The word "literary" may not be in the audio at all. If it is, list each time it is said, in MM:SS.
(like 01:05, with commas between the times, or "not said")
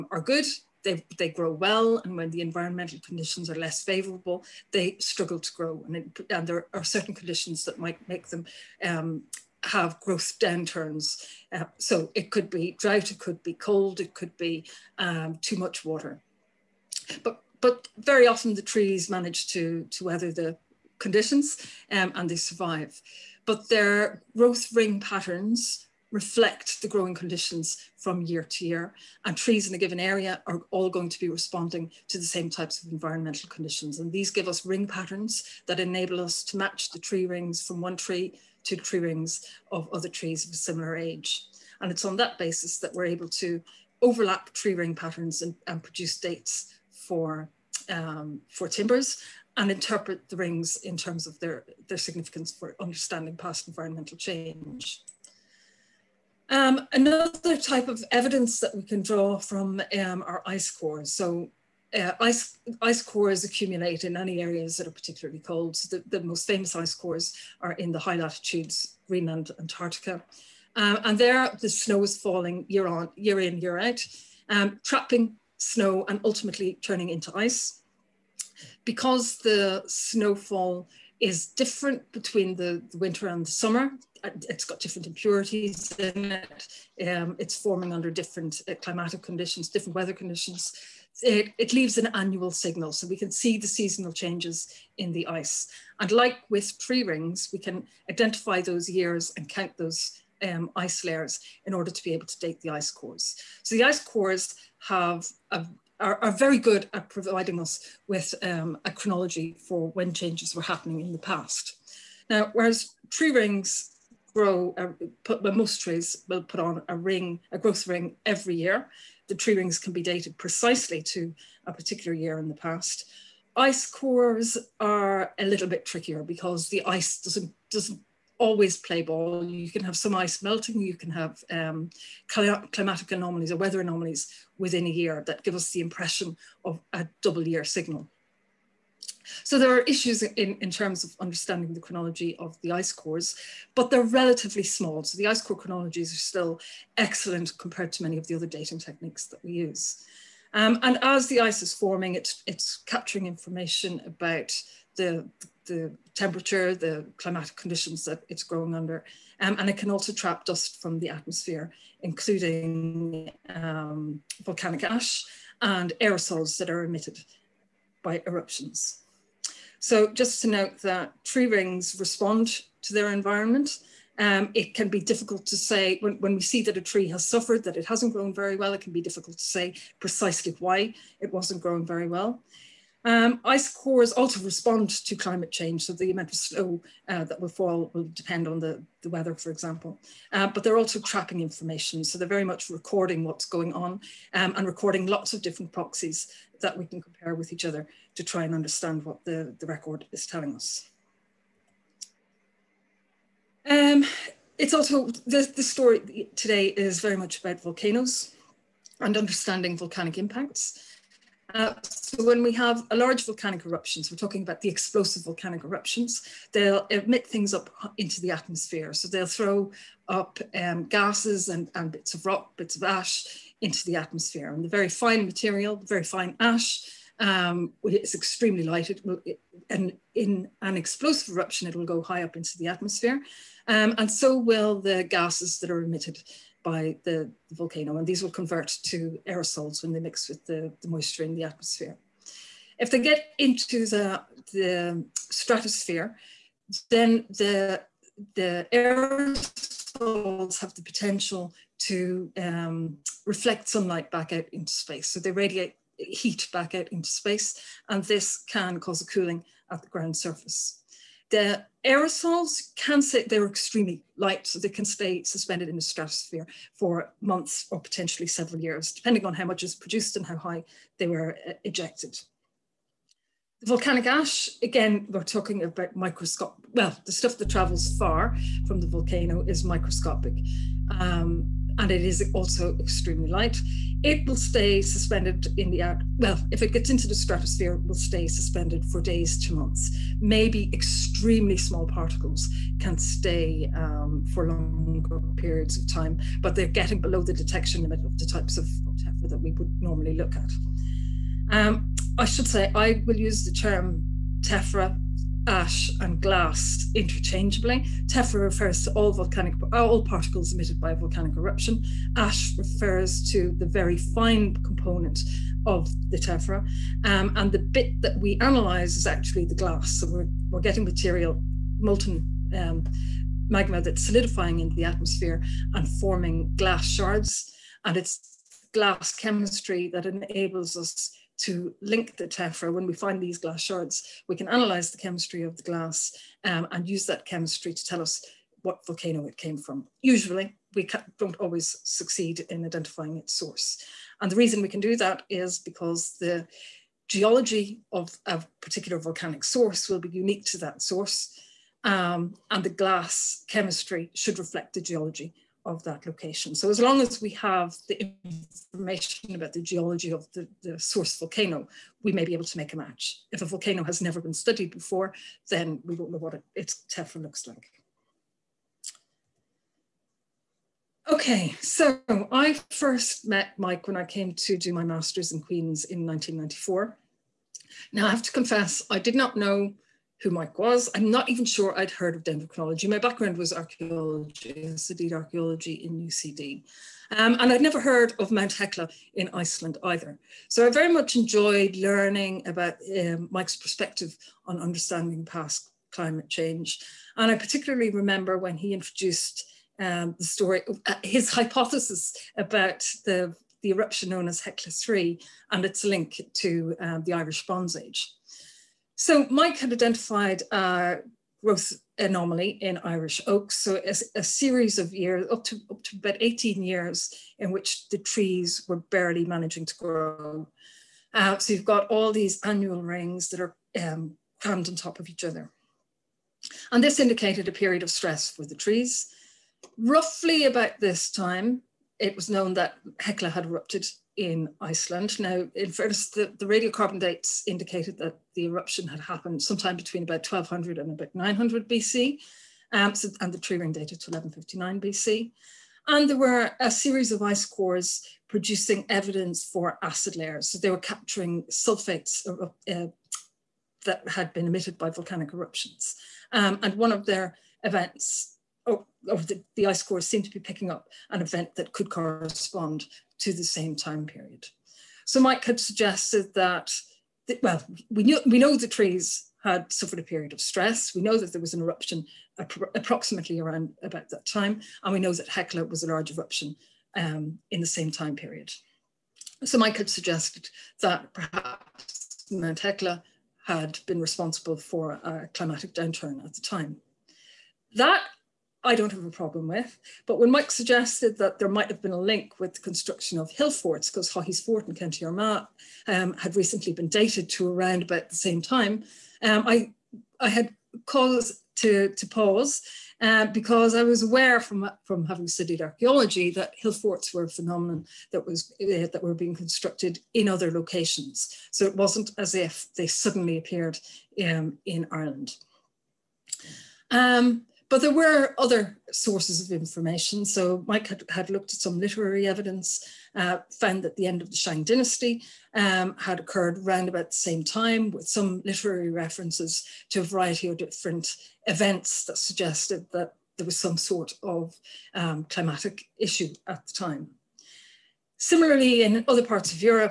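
08:41, 08:48.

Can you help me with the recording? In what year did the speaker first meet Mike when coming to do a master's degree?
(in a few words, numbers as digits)
1994.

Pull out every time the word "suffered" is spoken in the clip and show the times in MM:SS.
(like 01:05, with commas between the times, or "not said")
02:57, 07:49.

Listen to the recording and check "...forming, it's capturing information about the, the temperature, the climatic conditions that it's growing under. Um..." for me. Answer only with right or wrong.
right.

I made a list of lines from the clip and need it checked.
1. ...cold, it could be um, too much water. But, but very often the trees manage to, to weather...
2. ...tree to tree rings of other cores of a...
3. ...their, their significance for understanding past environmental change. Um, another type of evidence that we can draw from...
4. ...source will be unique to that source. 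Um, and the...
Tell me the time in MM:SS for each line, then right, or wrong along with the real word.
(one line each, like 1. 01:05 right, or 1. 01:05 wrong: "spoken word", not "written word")
1. 00:13 right
2. 00:37 wrong: "trees", not "cores"
3. 00:51 right
4. 05:49 right.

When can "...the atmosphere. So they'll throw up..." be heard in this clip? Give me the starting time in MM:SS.
03:38.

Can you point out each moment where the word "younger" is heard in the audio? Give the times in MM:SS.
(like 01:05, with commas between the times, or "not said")
not said.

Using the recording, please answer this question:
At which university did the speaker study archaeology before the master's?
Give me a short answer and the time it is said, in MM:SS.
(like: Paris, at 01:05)
UCD, at 06:25.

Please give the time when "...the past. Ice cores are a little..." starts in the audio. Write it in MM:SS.
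02:02.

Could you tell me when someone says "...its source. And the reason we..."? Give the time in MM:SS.
05:43.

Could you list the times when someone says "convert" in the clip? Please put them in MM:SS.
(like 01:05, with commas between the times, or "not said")
03:58.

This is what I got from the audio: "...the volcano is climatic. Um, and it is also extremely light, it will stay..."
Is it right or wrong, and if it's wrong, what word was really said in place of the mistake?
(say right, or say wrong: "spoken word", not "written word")
wrong: "microscopic", not "climatic".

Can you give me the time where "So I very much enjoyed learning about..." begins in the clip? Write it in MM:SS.
06:30.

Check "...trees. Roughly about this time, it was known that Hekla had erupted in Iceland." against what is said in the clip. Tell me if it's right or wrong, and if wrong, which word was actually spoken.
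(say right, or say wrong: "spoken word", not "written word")
right.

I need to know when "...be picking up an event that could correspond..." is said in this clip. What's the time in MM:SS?
07:40.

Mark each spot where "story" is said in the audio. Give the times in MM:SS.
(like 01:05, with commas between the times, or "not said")
03:25, 06:40.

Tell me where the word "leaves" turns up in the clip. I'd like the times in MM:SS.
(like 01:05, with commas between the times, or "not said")
01:31.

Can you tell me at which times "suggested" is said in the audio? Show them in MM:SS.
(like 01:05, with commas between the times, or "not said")
07:45, 07:59, 08:10, 08:52.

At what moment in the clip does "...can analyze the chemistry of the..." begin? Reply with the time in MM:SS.
05:34.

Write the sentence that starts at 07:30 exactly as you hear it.
So they were capturing sulfates uh, uh that had been emitted by volcanic eruptions.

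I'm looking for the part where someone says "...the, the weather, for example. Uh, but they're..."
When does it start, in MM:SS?
03:08.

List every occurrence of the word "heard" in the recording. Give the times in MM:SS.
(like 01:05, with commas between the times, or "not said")
06:21, 06:27.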